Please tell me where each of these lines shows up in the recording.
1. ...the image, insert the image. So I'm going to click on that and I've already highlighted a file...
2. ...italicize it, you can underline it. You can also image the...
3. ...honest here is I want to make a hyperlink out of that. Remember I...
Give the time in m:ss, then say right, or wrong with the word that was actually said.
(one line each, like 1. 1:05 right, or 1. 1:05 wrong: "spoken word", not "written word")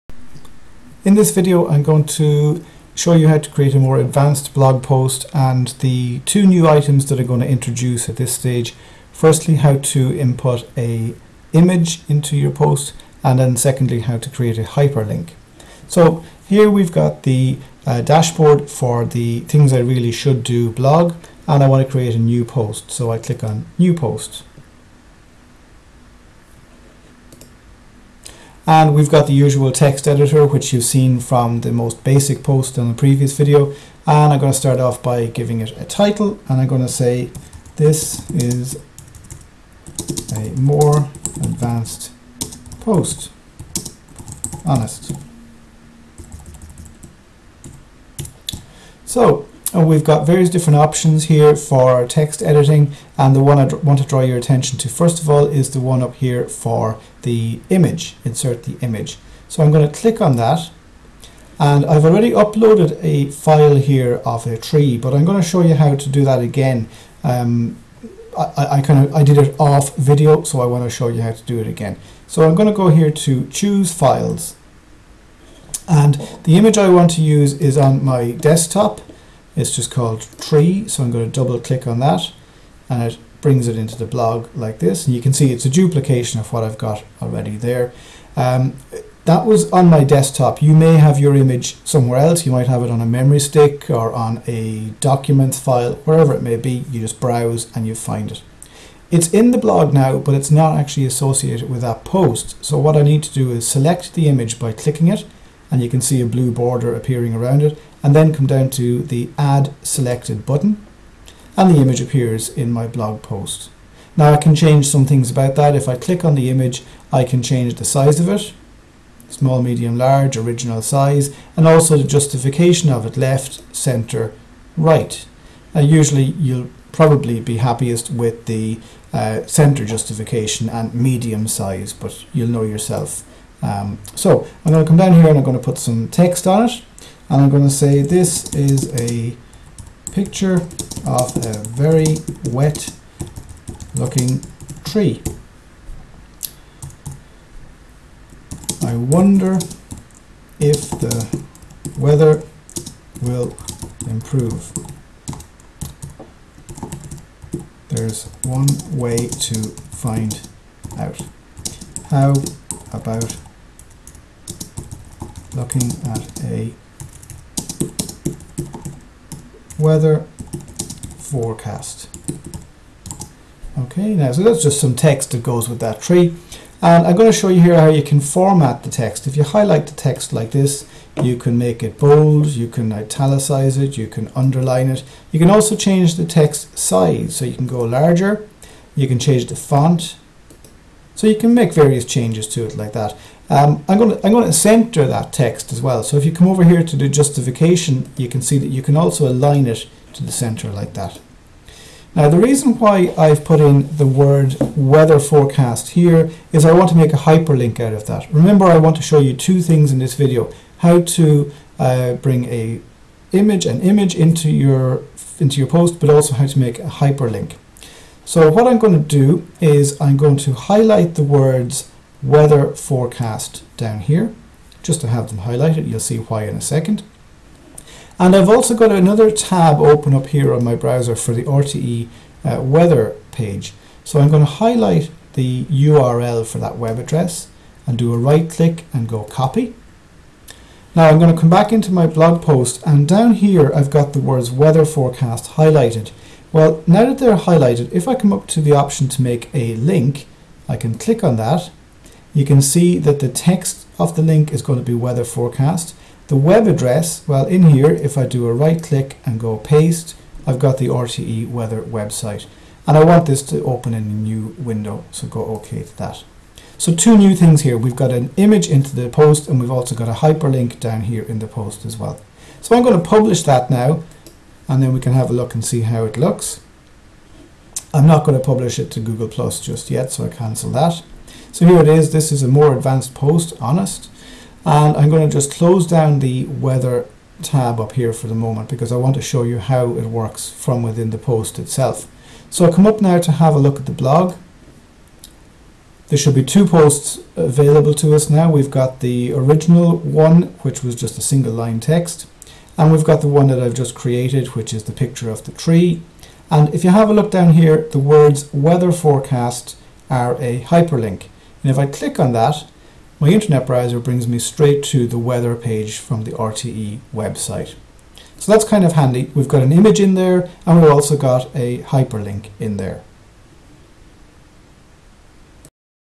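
1. 0:57 wrong: "uploaded", not "highlighted"
2. 3:02 wrong: "change", not "image"
3. 3:25 wrong: "forecast", not "honest".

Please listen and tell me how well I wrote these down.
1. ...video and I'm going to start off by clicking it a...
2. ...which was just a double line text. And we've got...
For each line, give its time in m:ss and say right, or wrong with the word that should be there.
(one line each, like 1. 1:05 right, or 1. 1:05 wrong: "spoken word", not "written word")
1. 0:33 wrong: "giving", not "clicking"
2. 5:00 wrong: "single", not "double".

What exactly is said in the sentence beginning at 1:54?
Now I can change some things about that.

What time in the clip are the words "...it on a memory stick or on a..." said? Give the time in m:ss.
1:32.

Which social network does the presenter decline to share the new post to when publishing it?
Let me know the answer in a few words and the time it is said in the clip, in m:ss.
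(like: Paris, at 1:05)
Google Plus, at 4:39.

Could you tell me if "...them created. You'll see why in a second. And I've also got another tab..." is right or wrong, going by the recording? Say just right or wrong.
wrong.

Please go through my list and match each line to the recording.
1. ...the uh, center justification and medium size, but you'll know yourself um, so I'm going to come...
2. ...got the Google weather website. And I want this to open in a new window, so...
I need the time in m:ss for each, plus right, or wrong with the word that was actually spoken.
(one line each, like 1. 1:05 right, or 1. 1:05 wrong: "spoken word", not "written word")
1. 2:08 right
2. 4:20 wrong: "RTE", not "Google".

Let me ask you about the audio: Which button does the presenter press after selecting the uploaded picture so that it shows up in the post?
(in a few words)
add selected.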